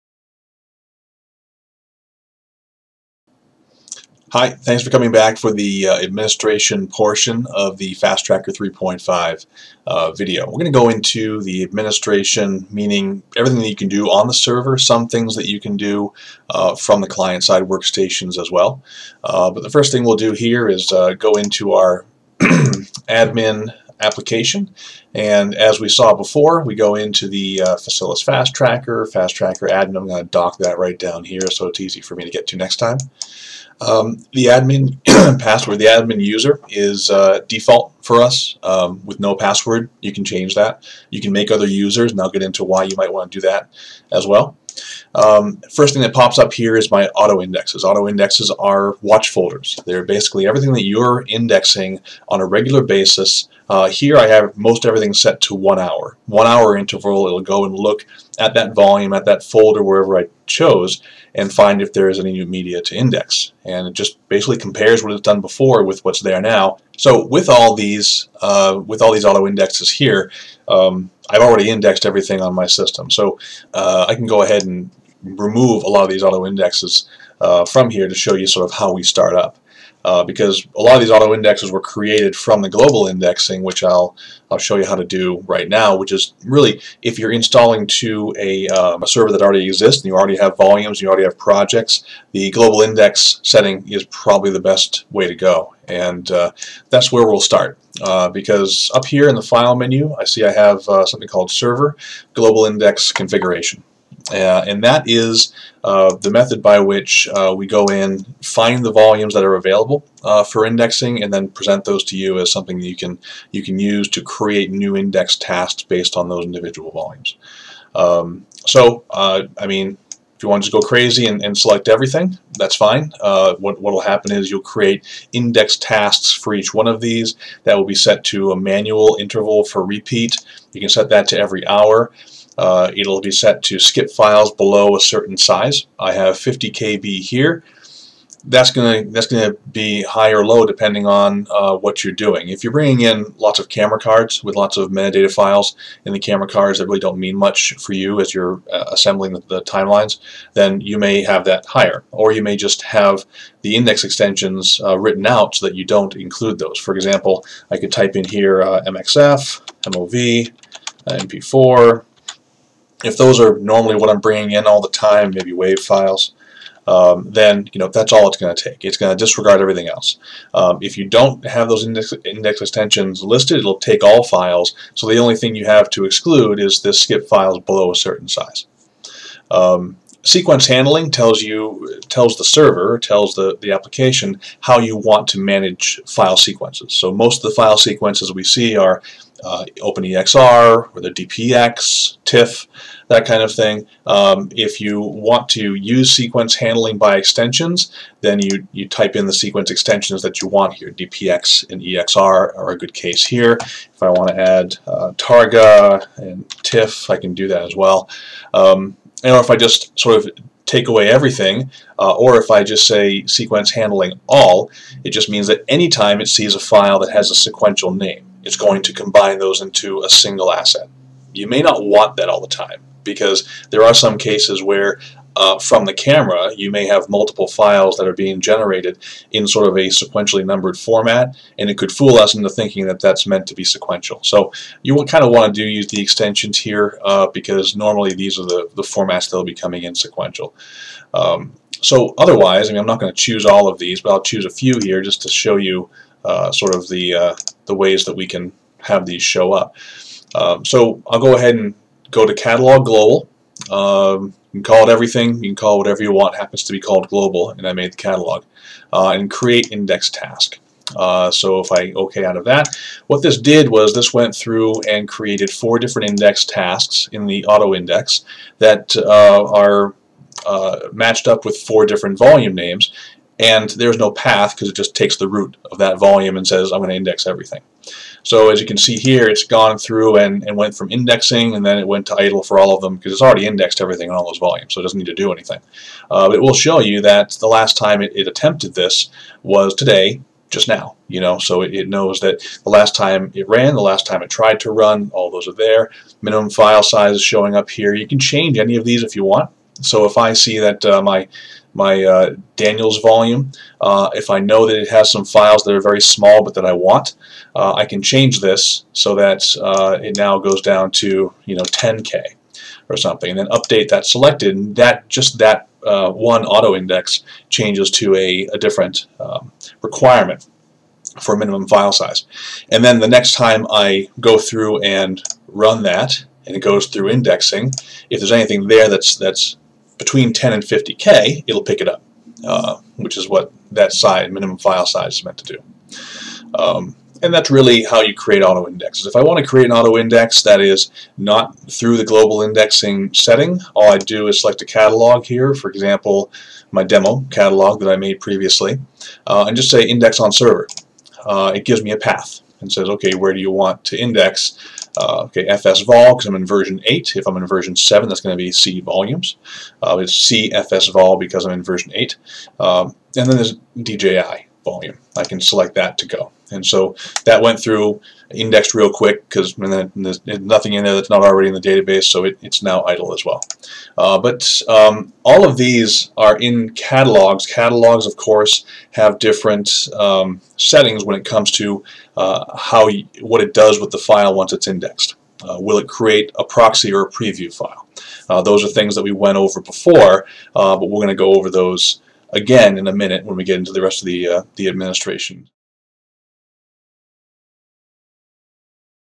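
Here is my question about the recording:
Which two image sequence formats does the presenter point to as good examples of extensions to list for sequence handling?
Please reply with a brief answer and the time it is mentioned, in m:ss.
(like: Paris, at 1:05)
DPX and EXR, at 3:20.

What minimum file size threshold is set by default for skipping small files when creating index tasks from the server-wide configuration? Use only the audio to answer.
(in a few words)
50 KB.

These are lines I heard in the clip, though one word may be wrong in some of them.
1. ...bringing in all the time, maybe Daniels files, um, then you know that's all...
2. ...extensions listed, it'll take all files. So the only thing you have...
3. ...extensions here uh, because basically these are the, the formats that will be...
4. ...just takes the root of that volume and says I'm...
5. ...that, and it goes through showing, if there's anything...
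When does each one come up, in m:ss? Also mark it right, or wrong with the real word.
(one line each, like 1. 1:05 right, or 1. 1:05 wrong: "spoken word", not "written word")
1. 2:44 wrong: "WAV", not "Daniels"
2. 2:52 right
3. 3:56 wrong: "normally", not "basically"
4. 4:34 right
5. 5:25 wrong: "indexing", not "showing".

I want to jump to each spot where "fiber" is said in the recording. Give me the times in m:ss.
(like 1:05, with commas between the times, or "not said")
not said.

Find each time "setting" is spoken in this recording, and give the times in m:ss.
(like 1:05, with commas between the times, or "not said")
1:33, 5:43, 6:20.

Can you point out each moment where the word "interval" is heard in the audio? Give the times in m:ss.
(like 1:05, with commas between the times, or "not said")
0:56, 2:09.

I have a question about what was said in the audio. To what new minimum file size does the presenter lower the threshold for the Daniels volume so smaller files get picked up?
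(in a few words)
10k.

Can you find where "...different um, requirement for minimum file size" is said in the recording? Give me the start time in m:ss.
5:18.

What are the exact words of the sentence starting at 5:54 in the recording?
Uh, okay, FS vol, because I'm in version 8.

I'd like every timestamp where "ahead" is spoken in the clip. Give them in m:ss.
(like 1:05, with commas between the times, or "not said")
1:14, 4:11.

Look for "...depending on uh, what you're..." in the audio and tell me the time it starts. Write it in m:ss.
2:20.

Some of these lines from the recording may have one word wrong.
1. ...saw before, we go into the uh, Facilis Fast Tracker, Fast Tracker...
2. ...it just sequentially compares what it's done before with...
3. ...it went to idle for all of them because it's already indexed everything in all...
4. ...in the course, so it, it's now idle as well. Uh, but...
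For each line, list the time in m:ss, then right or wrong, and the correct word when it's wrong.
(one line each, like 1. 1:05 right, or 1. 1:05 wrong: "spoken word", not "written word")
1. 0:25 right
2. 1:03 wrong: "basically", not "sequentially"
3. 4:41 right
4. 6:11 wrong: "database", not "course".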